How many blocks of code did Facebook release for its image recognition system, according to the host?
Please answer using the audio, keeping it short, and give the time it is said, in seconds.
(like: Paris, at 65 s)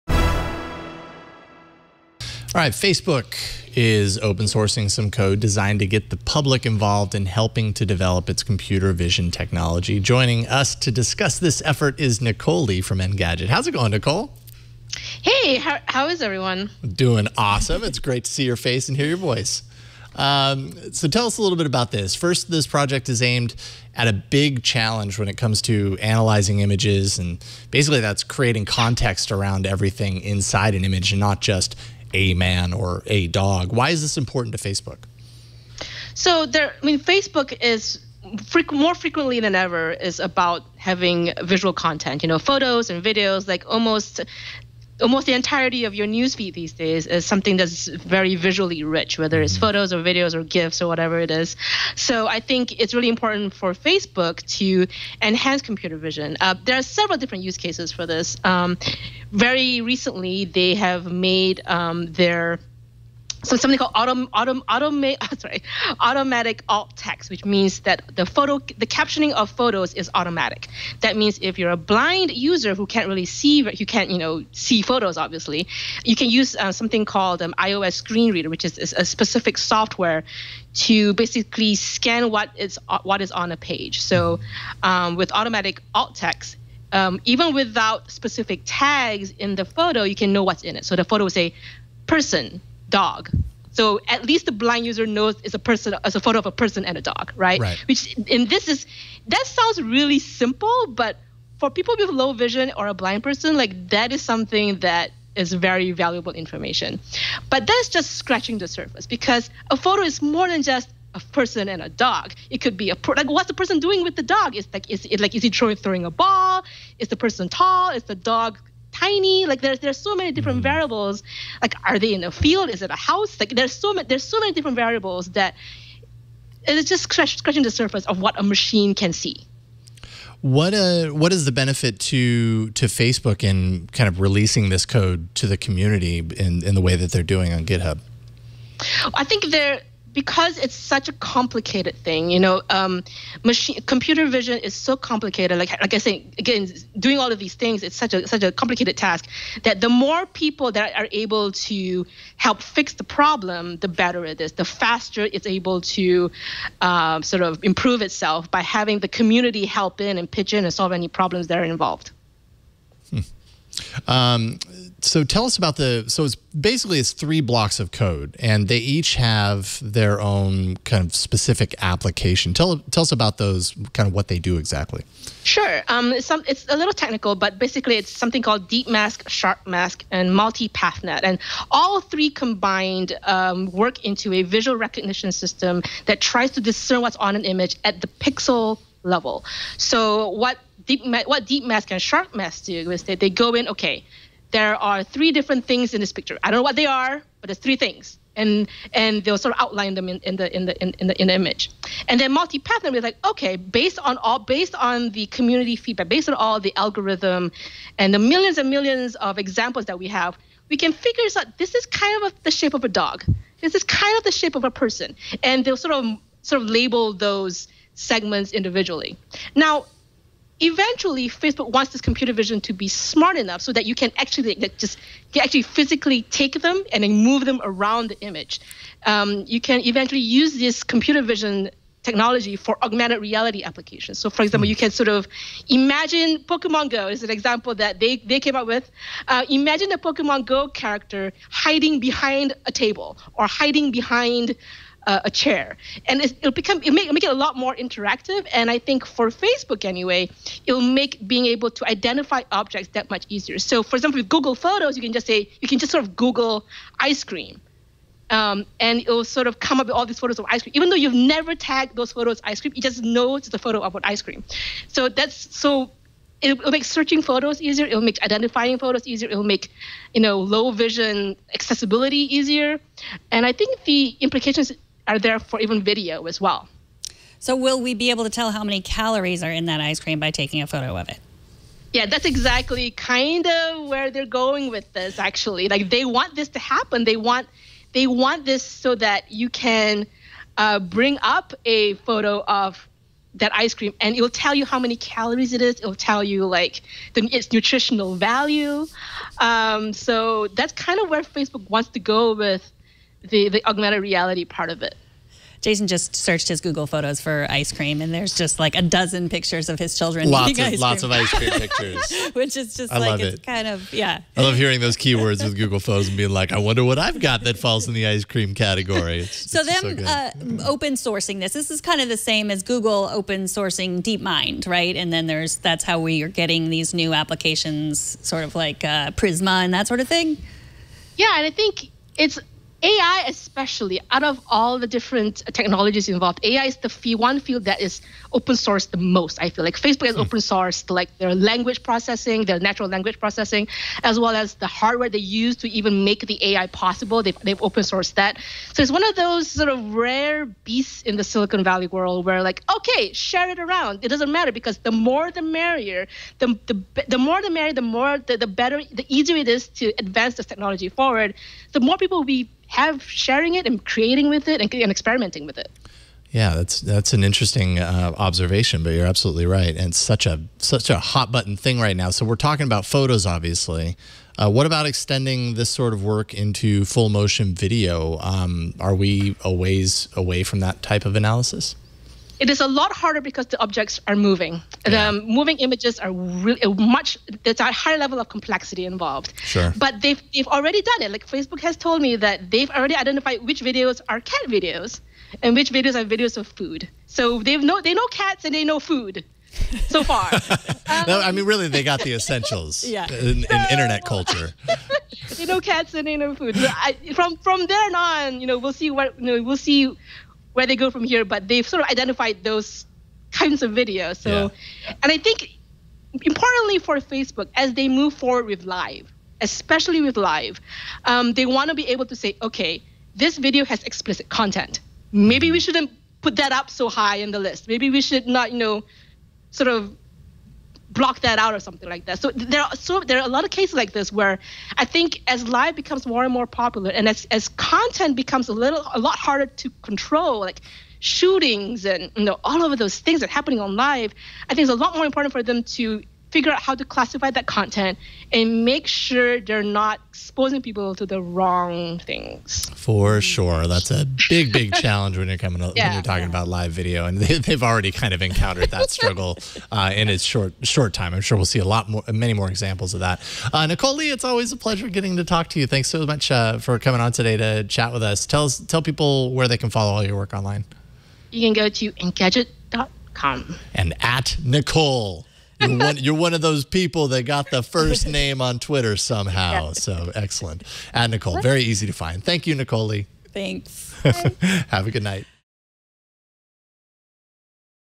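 3, at 167 s.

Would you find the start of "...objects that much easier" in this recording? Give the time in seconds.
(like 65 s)
252 s.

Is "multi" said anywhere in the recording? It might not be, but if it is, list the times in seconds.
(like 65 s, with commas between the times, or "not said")
180 s, 202 s.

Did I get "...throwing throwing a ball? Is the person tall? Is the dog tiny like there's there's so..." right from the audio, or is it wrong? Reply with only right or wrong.
right.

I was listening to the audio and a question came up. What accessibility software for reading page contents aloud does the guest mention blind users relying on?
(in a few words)
iOS Screen Reader.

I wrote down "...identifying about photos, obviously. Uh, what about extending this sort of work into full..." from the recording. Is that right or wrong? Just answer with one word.
wrong.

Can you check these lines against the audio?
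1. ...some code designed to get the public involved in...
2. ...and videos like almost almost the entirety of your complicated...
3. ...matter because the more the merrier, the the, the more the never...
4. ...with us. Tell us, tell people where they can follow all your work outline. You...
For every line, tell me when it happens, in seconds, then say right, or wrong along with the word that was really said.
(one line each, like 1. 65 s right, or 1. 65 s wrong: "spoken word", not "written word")
1. 4 s right
2. 42 s wrong: "newsfeed", not "complicated"
3. 354 s wrong: "merrier", not "never"
4. 467 s wrong: "online", not "outline".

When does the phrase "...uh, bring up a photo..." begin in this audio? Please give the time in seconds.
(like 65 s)
290 s.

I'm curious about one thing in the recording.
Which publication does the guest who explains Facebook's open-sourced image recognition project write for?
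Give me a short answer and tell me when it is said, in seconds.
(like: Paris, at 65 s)
Engadget, at 12 s.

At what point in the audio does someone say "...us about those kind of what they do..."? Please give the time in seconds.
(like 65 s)
173 s.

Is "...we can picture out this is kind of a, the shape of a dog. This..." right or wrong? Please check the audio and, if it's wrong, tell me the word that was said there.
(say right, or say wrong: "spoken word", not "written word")
wrong: "figure", not "picture".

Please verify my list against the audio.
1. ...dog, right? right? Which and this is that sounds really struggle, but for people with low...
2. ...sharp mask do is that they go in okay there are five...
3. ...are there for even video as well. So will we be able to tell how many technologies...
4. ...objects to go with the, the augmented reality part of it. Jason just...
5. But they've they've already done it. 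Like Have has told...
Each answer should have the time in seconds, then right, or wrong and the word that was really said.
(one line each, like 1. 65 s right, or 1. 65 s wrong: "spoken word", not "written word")
1. 97 s wrong: "simple", not "struggle"
2. 192 s wrong: "three", not "five"
3. 275 s wrong: "calories", not "technologies"
4. 301 s wrong: "wants", not "objects"
5. 389 s wrong: "Facebook", not "Have".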